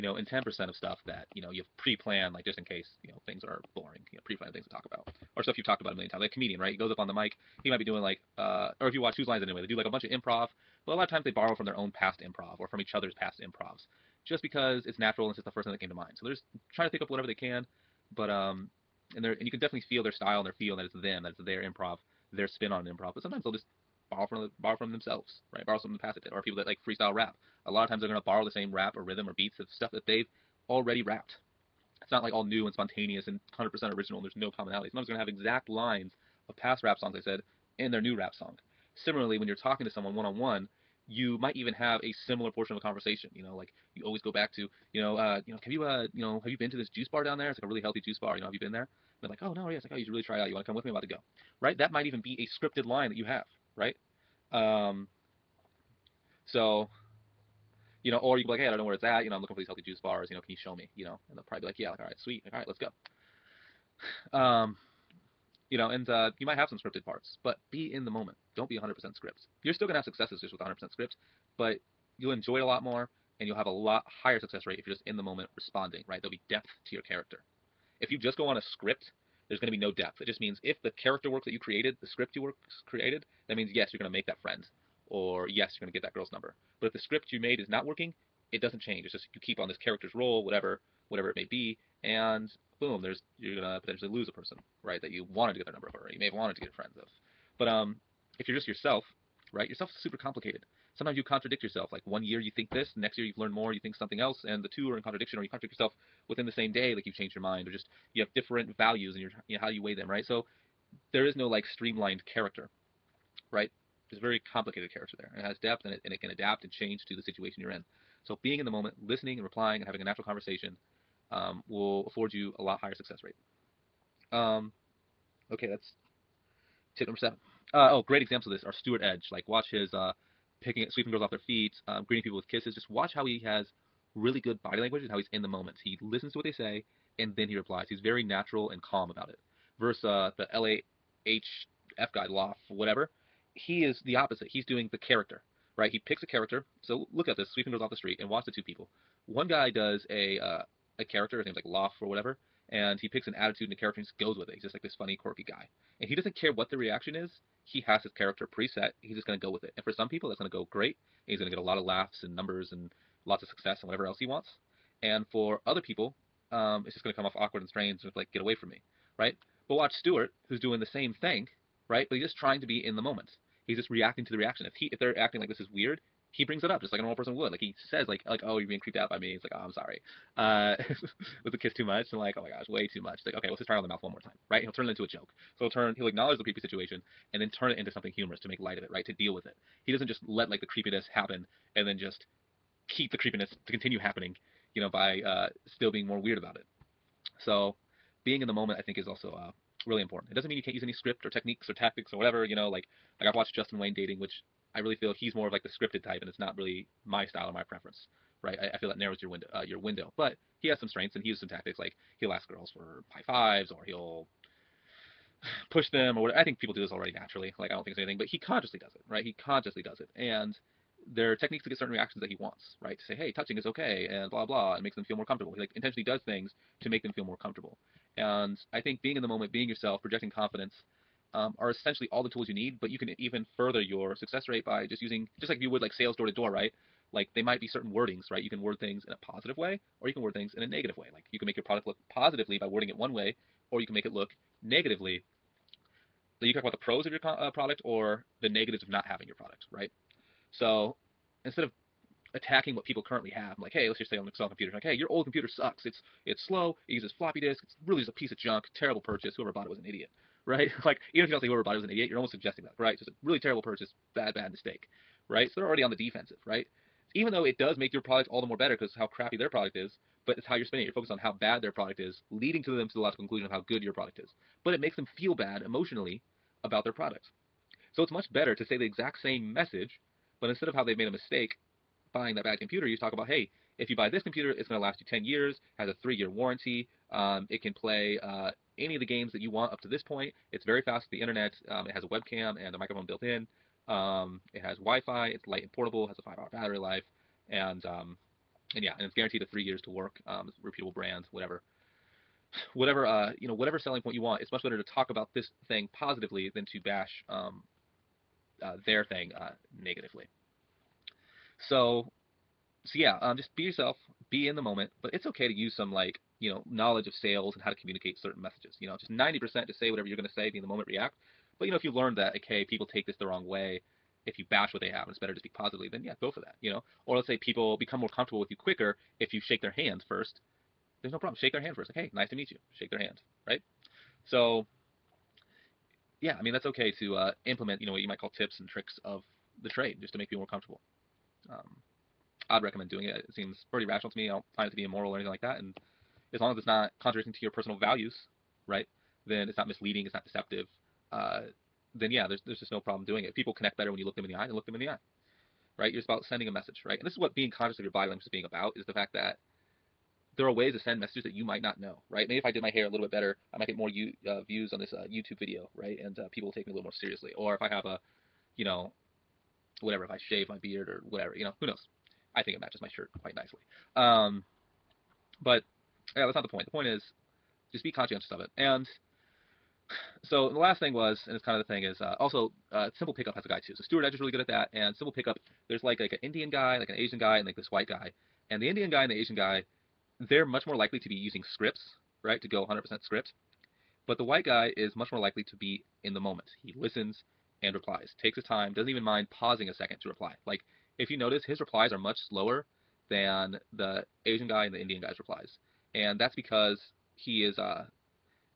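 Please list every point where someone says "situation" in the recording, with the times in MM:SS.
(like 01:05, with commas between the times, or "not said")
01:57, 03:06.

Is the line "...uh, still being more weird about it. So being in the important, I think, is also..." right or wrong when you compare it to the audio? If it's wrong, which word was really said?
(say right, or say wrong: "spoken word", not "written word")
wrong: "moment", not "important".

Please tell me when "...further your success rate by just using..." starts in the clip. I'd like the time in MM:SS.
03:53.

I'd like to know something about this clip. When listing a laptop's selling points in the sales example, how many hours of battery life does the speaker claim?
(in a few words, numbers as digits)
5 hours.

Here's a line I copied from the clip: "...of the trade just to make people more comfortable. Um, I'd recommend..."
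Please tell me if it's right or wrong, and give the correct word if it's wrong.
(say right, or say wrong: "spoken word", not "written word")
right.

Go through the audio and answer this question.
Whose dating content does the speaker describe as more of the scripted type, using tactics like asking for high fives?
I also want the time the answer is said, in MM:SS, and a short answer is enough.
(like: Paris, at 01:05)
Justin Wayne, at 03:23.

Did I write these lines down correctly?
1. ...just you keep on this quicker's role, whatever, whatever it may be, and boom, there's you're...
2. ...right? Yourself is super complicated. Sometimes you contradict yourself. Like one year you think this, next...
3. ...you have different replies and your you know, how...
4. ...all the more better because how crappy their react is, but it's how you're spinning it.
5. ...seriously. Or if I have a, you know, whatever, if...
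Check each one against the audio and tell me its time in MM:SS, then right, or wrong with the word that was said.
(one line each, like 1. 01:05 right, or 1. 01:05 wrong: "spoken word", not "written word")
1. 01:29 wrong: "character", not "quicker"
2. 01:39 right
3. 01:48 wrong: "values", not "replies"
4. 04:28 wrong: "product", not "react"
5. 06:07 right.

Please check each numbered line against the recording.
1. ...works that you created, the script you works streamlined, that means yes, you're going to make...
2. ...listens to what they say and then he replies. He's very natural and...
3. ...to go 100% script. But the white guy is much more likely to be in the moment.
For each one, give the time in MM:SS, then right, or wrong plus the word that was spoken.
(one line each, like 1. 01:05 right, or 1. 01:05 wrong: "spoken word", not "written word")
1. 01:21 wrong: "created", not "streamlined"
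2. 02:16 right
3. 06:32 right.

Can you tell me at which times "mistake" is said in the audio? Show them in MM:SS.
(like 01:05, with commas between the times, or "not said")
04:24, 04:41.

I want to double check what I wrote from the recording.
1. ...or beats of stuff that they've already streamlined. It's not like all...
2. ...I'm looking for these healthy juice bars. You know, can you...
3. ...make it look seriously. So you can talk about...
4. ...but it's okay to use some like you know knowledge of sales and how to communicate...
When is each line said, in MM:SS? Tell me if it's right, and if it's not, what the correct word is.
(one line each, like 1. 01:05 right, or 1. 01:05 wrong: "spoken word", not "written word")
1. 00:29 wrong: "rapped", not "streamlined"
2. 00:59 right
3. 04:03 wrong: "negatively", not "seriously"
4. 05:15 right.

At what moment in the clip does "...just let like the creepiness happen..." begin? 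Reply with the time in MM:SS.
03:10.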